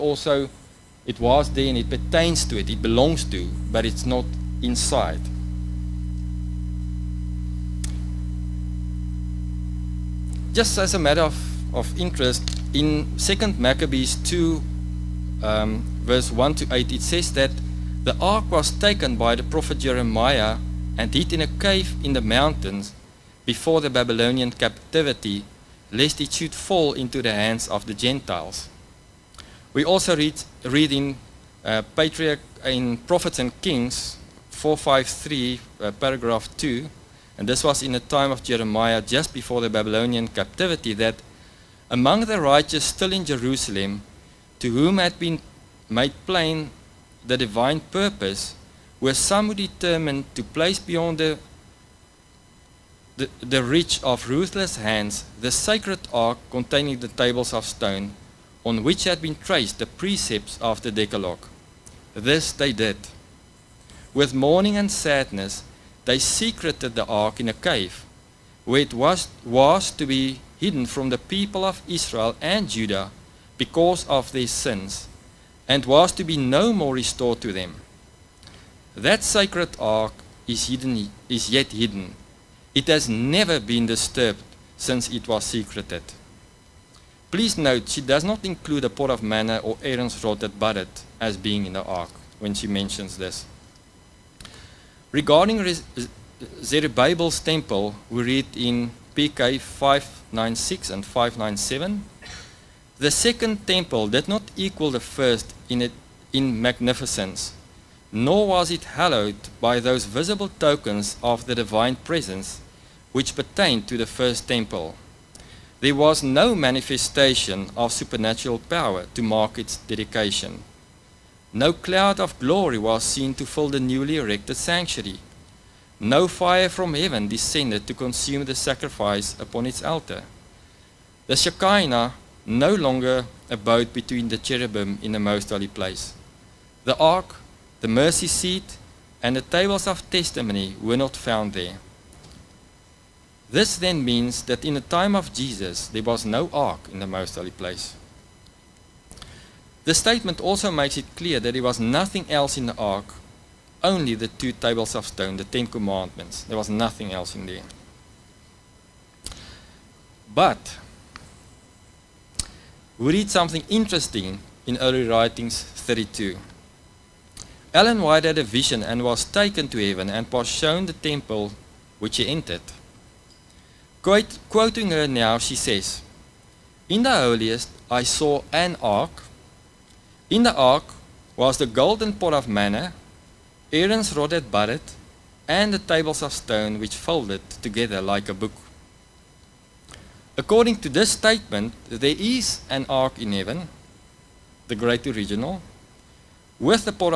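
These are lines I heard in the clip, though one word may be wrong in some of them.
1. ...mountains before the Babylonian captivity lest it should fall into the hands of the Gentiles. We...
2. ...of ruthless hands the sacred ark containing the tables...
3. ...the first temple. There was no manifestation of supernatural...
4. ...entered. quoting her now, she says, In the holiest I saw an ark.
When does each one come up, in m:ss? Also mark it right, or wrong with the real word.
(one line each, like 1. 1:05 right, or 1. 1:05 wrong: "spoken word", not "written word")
1. 0:22 right
2. 0:54 right
3. 1:53 right
4. 2:52 right.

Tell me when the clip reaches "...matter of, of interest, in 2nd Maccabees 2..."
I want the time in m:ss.
0:10.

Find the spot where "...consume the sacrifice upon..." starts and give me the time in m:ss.
2:07.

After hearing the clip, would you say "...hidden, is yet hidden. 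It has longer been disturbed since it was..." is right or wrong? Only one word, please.
wrong.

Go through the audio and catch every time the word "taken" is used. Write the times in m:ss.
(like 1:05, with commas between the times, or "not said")
0:18, 2:49.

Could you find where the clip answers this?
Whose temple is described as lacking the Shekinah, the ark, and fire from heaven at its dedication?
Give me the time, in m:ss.
1:36.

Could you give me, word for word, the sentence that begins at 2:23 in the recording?
This then means that in the time of Jesus, there was no ark in the most holy place.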